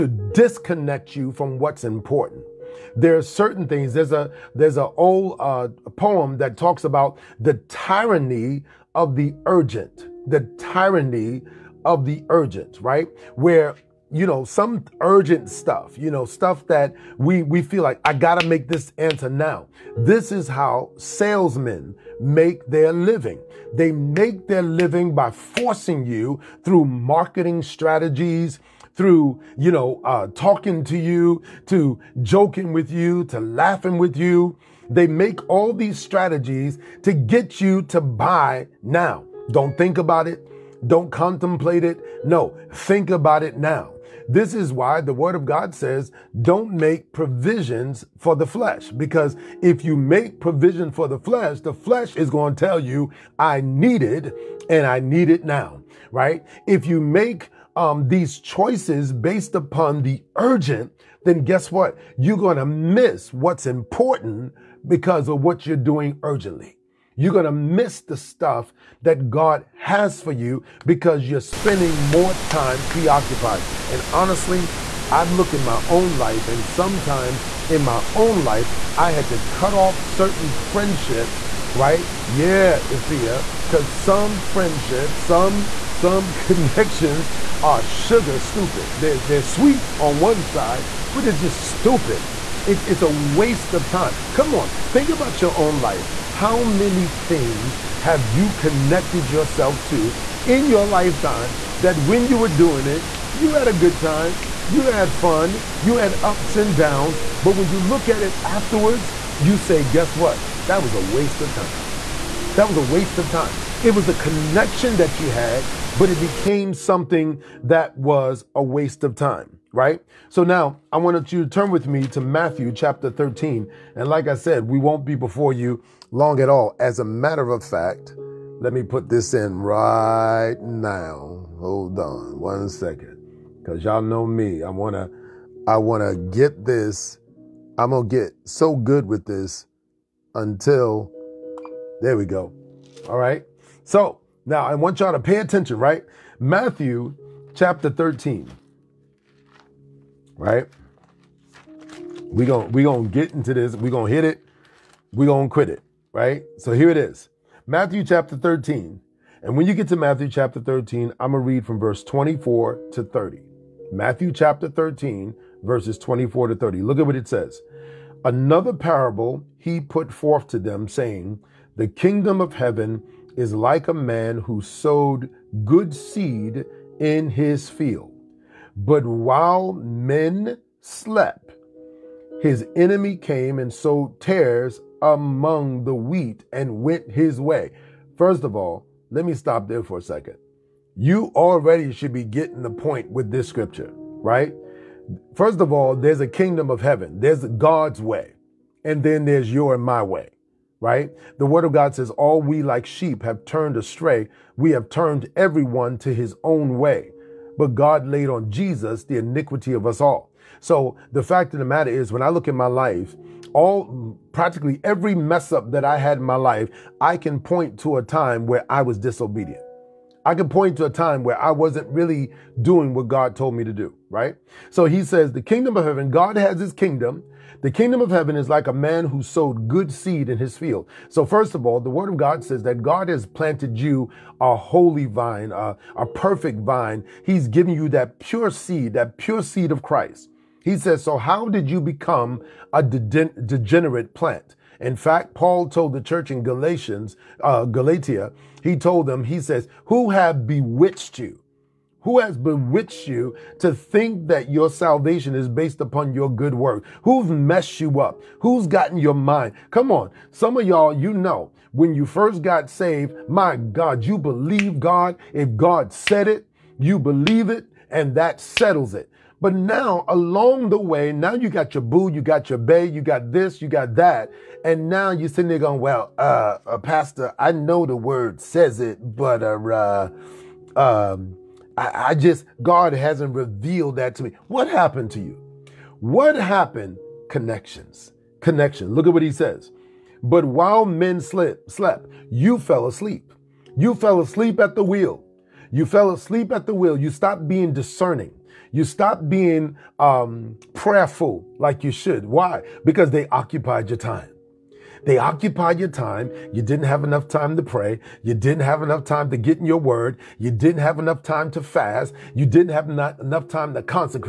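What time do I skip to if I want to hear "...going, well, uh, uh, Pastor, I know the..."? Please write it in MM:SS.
04:35.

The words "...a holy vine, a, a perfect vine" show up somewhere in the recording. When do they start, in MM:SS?
03:54.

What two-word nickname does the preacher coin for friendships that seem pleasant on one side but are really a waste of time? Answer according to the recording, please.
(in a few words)
Sugar stupid.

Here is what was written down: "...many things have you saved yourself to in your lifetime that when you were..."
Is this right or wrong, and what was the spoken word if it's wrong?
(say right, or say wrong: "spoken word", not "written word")
wrong: "connected", not "saved".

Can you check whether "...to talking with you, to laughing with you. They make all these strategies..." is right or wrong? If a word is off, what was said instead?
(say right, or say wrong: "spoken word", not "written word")
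wrong: "joking", not "talking".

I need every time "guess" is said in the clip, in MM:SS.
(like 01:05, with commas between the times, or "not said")
01:01, 01:49.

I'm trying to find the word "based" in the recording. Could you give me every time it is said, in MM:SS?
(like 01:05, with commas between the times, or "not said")
00:59, 04:15.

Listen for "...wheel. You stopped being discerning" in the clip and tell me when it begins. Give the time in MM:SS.
04:56.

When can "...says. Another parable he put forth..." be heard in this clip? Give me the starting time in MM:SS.
02:47.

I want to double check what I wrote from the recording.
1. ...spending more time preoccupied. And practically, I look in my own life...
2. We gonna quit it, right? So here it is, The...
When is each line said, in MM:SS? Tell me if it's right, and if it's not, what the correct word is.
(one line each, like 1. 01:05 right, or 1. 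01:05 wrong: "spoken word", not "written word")
1. 01:11 wrong: "honestly", not "practically"
2. 02:35 wrong: "Matthew", not "The".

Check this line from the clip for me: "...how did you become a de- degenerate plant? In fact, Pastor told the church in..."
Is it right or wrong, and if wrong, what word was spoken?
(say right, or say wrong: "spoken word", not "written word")
wrong: "Paul", not "Pastor".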